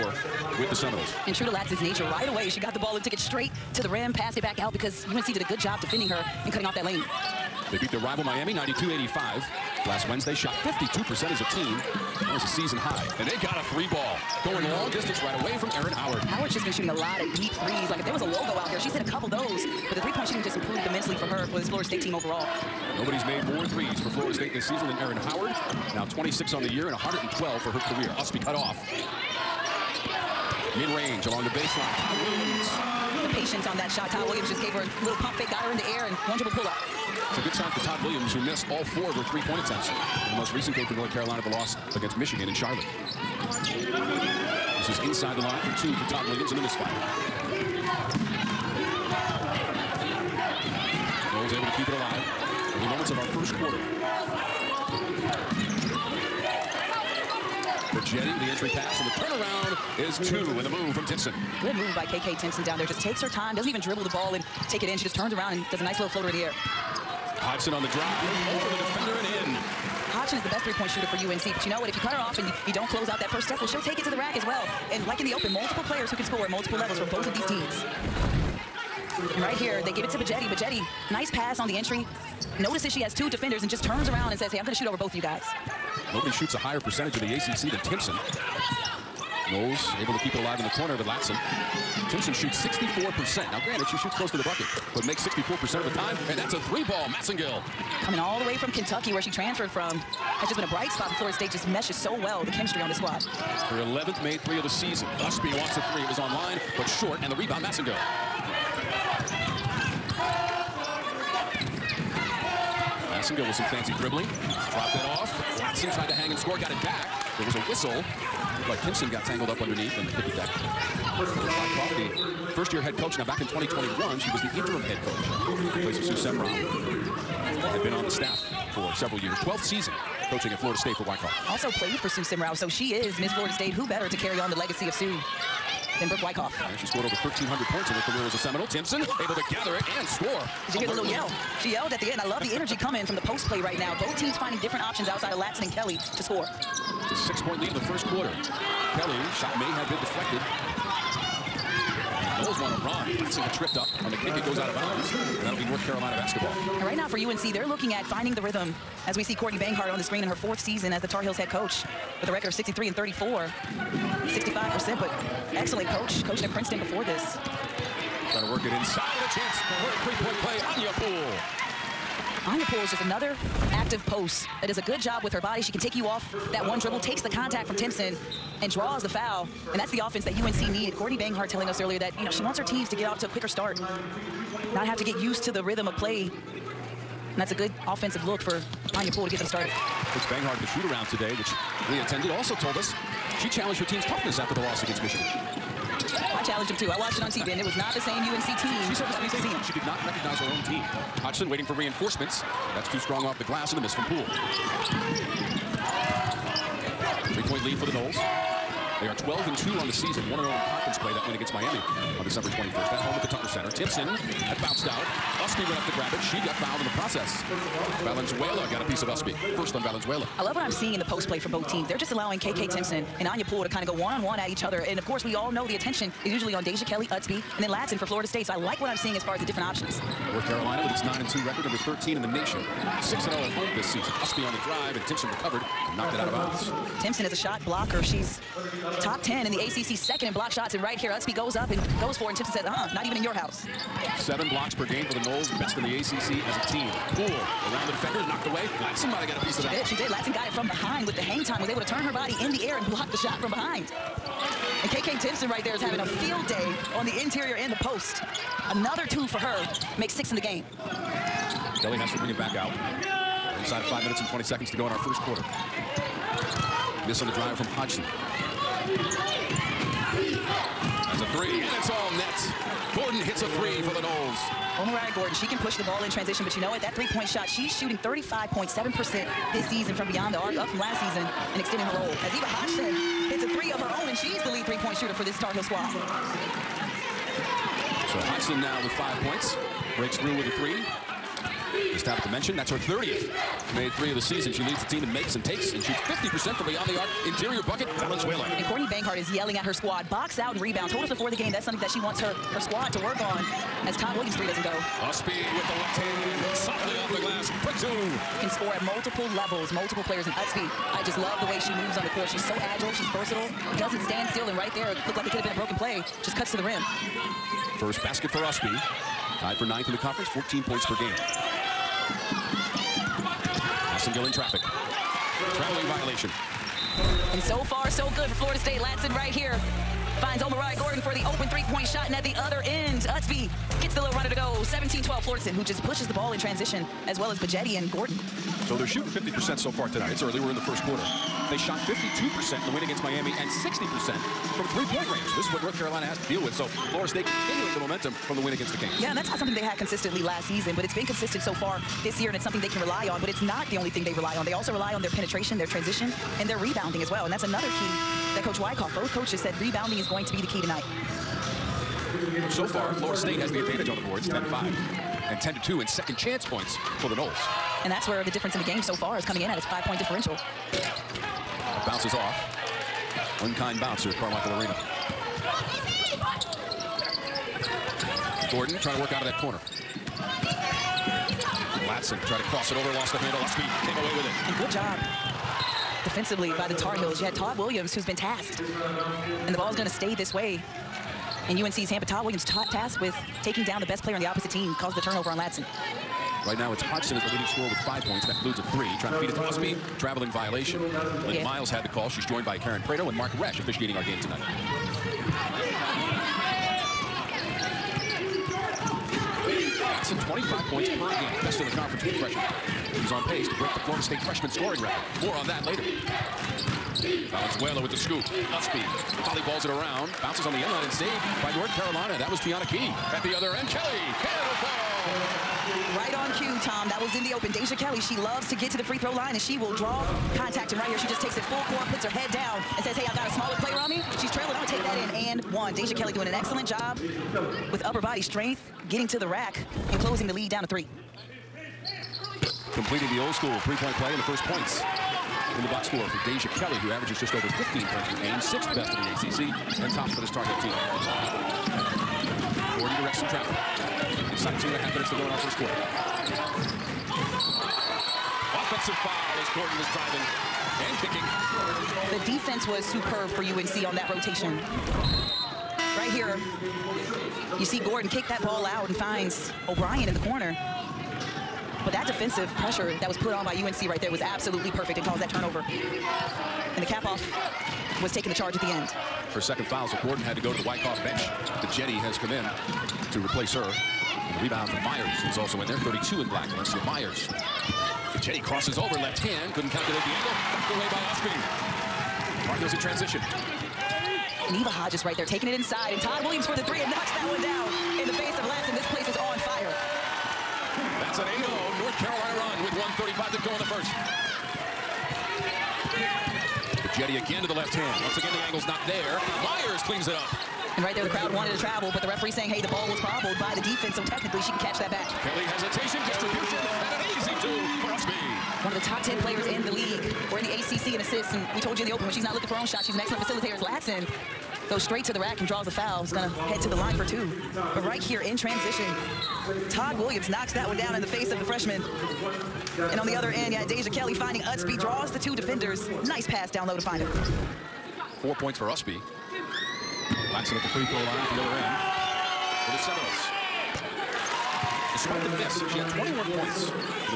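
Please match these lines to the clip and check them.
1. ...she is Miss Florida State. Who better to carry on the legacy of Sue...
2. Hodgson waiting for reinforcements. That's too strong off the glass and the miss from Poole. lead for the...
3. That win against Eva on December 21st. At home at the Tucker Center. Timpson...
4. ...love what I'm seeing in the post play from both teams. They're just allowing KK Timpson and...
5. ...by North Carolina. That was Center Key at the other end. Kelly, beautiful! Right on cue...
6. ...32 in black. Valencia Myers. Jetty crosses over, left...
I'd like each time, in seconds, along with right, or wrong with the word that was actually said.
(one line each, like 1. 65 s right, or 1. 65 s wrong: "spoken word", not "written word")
1. 132 s right
2. 201 s right
3. 211 s wrong: "Miami", not "Eva"
4. 220 s right
5. 421 s wrong: "Teonni", not "Center"
6. 485 s right.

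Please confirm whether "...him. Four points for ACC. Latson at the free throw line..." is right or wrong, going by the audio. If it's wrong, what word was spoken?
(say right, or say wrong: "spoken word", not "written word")
wrong: "Ustby", not "ACC".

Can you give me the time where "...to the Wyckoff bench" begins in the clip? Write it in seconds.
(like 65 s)
480 s.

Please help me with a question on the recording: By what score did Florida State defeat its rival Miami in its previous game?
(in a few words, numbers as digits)
92-85.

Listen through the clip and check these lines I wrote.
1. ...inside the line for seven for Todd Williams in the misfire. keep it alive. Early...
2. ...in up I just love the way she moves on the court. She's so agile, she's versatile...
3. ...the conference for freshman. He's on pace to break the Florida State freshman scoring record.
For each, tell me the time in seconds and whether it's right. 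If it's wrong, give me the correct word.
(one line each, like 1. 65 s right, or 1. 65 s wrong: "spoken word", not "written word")
1. 45 s wrong: "two", not "seven"
2. 310 s right
3. 411 s right.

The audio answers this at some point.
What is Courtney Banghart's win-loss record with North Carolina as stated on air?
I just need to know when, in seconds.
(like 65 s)
162 s.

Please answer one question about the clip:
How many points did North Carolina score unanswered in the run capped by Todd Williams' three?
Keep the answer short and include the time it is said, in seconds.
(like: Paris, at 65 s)
8, at 501 s.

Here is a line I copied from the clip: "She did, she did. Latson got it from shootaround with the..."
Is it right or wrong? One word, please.
wrong.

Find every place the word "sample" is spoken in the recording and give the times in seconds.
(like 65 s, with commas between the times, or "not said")
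not said.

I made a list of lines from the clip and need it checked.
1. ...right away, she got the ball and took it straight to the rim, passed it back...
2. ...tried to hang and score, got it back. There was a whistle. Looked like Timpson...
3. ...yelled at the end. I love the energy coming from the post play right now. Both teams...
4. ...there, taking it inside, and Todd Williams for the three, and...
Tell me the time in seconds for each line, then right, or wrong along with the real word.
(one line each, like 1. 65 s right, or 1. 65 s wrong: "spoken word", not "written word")
1. 2 s right
2. 115 s right
3. 141 s right
4. 495 s right.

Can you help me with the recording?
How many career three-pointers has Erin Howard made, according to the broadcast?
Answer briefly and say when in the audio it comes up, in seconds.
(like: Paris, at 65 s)
112, at 26 s.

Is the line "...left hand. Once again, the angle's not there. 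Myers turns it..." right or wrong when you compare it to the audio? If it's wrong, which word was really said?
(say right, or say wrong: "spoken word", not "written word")
wrong: "cleans", not "turns".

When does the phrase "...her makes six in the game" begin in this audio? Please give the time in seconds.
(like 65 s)
259 s.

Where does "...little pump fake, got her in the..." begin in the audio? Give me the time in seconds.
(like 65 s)
35 s.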